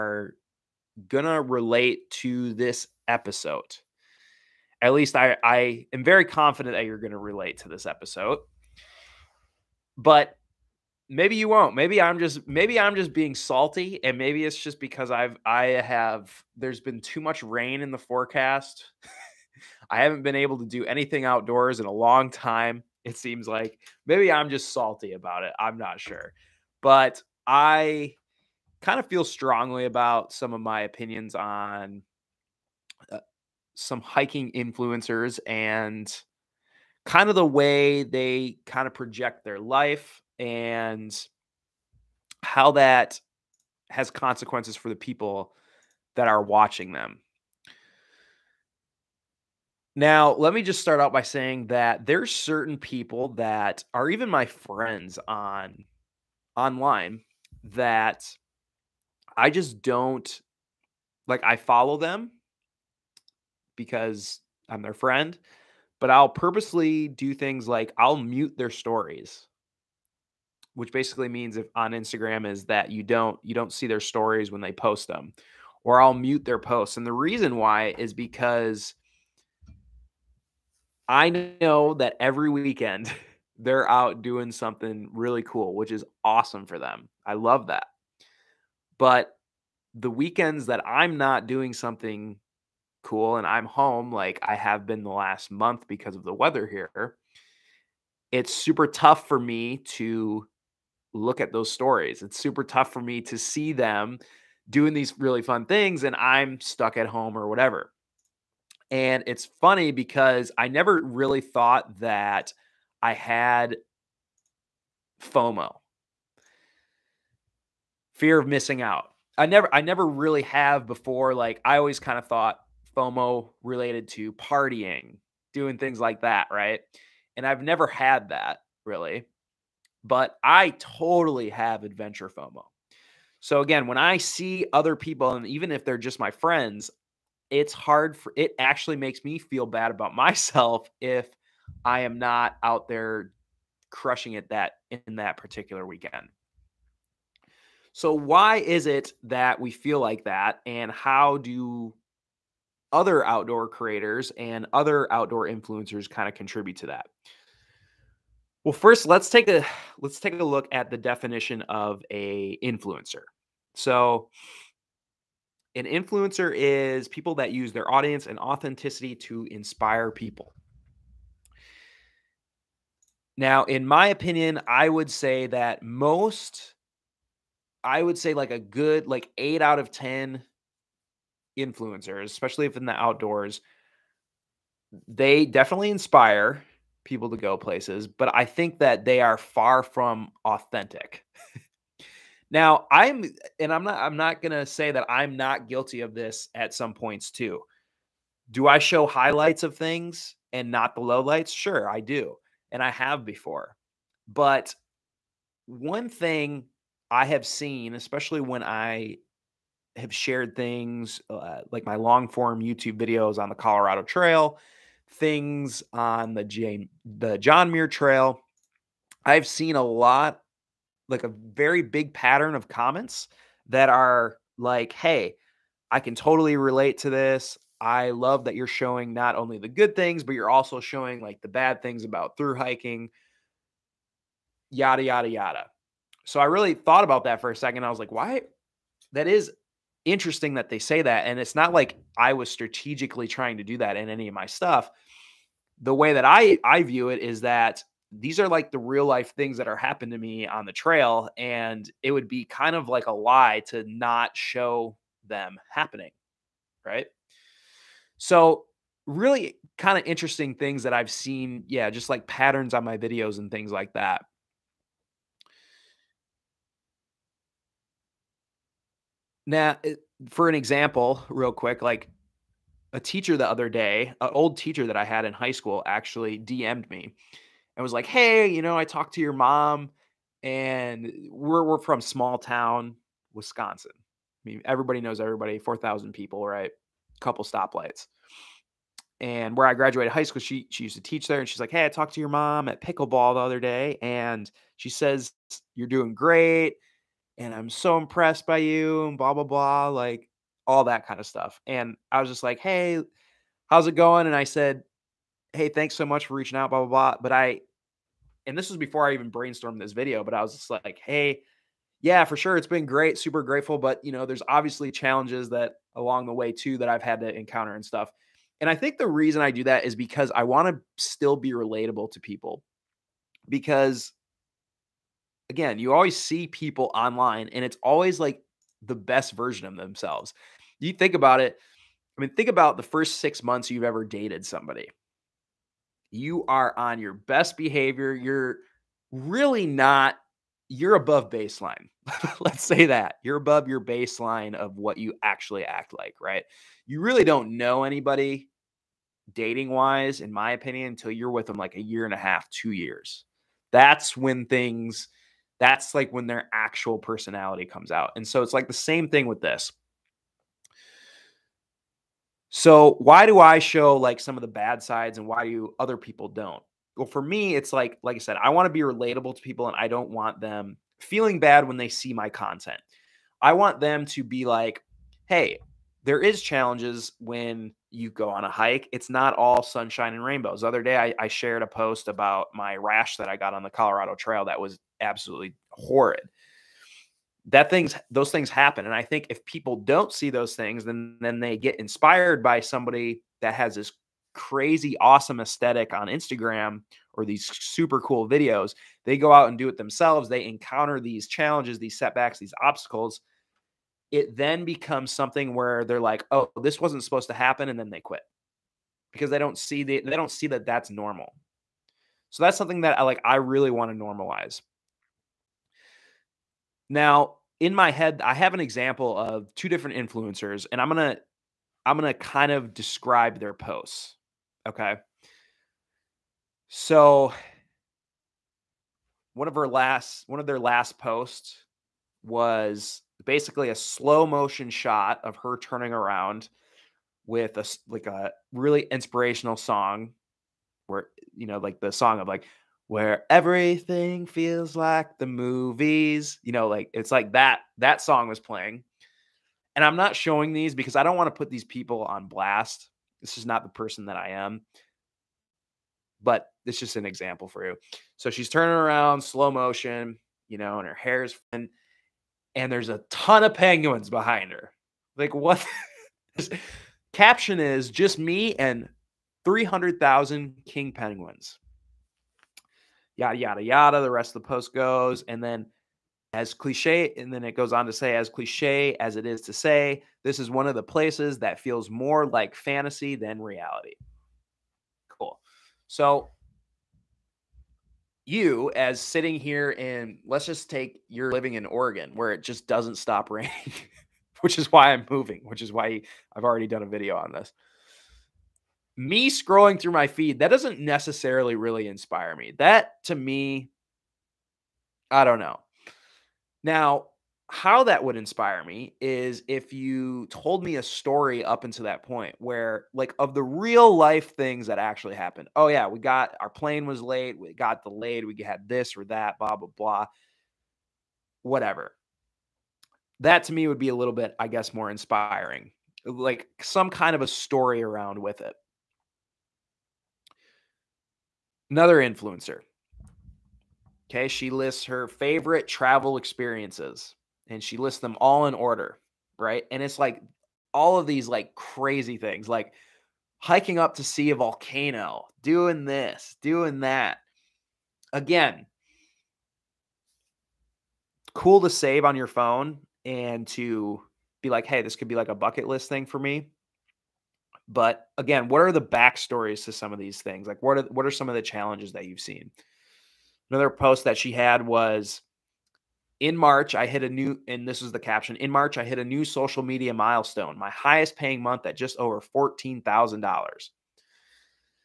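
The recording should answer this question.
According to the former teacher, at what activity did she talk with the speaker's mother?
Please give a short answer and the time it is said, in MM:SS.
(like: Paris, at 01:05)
pickleball, at 04:52.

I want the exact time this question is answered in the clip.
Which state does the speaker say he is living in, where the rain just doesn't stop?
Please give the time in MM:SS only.
08:11.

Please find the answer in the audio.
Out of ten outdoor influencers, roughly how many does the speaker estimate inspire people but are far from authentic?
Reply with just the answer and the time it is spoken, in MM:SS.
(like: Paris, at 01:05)
8, at 02:59.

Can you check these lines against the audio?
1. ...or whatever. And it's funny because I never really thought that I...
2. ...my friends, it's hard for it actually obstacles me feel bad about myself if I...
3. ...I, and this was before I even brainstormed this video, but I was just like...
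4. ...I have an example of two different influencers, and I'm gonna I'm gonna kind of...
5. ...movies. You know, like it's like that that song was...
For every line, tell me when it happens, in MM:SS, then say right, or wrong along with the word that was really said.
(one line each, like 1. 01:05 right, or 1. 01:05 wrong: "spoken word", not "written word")
1. 01:47 right
2. 02:16 wrong: "makes", not "obstacles"
3. 05:07 right
4. 06:58 right
5. 07:25 right.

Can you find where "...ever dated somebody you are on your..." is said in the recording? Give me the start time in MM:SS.
05:33.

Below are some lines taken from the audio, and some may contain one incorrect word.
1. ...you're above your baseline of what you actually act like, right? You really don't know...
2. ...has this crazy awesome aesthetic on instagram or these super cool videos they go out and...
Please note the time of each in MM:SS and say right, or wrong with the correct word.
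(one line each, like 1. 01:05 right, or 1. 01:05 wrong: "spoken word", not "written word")
1. 05:43 right
2. 06:33 right.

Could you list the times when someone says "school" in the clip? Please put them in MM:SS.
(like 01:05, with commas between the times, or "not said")
04:35, 04:50.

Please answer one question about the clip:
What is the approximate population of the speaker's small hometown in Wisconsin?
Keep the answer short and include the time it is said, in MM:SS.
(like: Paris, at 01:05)
4,000, at 04:45.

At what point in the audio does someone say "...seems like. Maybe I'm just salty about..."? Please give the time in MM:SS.
00:23.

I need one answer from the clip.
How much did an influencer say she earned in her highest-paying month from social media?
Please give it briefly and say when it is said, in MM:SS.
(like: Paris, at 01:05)
just over $14,000, at 09:31.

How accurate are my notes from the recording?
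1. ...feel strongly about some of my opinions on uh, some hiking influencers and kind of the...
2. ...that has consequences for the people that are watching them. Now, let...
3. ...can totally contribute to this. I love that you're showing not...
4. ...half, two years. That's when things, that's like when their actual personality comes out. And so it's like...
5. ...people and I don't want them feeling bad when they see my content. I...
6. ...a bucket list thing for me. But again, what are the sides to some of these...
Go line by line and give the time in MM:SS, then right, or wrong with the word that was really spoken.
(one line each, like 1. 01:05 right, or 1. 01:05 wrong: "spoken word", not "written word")
1. 00:29 right
2. 00:42 right
3. 03:45 wrong: "relate", not "contribute"
4. 05:52 right
5. 06:09 right
6. 09:15 wrong: "backstories", not "sides".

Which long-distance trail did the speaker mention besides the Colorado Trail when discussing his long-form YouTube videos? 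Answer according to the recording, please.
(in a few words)
John Muir Trail.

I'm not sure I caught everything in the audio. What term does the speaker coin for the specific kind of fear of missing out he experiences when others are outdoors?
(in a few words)
adventure FOMO.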